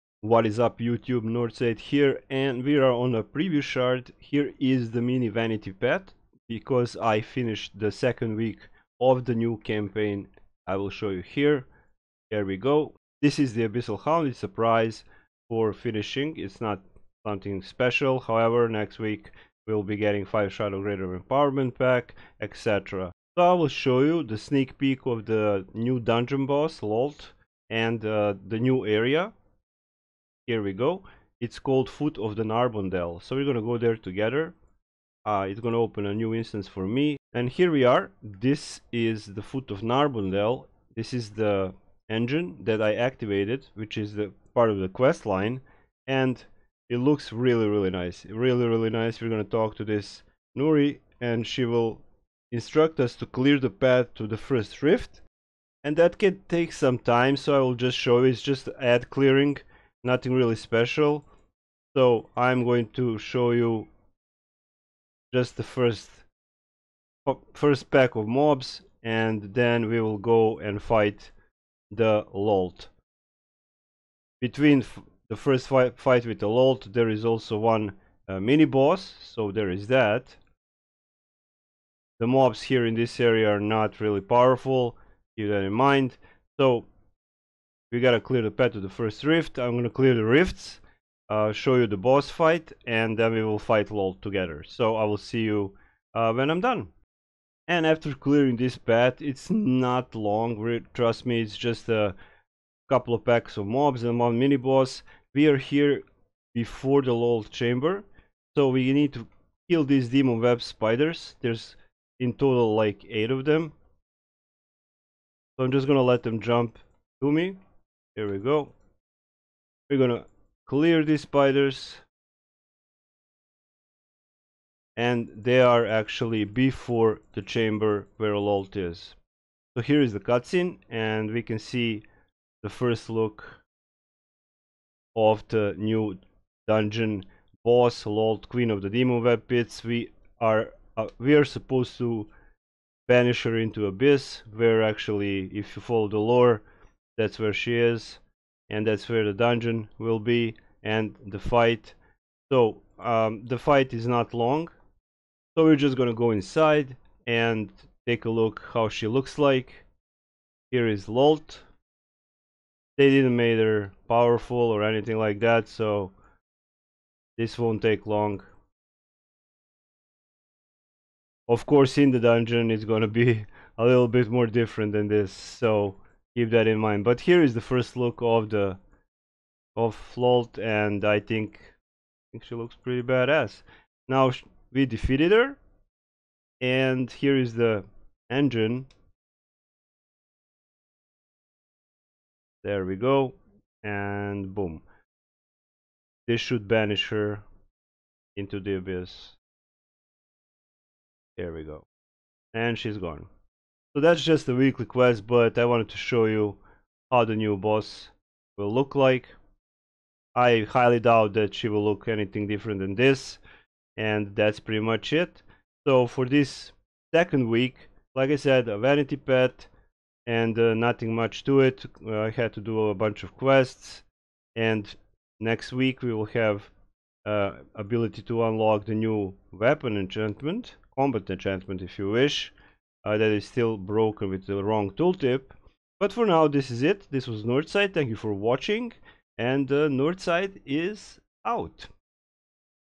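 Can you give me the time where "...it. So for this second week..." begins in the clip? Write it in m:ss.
3:35.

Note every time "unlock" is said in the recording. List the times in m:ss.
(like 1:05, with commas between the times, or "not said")
3:48.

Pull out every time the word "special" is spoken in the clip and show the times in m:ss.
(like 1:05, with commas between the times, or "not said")
0:17, 1:00.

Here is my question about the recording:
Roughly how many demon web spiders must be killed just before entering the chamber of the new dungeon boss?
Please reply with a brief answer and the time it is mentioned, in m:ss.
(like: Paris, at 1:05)
8, at 1:53.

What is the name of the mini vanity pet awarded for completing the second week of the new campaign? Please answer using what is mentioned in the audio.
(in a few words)
Abyssal Hound.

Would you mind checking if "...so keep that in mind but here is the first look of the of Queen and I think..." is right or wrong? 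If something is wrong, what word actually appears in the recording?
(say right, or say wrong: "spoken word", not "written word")
wrong: "Flolt", not "Queen".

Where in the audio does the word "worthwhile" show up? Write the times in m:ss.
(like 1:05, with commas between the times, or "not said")
not said.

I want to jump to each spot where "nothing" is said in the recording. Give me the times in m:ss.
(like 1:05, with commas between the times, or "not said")
1:00, 3:40.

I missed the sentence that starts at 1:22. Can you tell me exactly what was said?
The mobs here in this area are not really powerful keep that in mind.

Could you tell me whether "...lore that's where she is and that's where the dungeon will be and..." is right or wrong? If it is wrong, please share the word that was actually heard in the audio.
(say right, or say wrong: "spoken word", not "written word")
right.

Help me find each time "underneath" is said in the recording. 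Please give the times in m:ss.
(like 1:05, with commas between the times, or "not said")
not said.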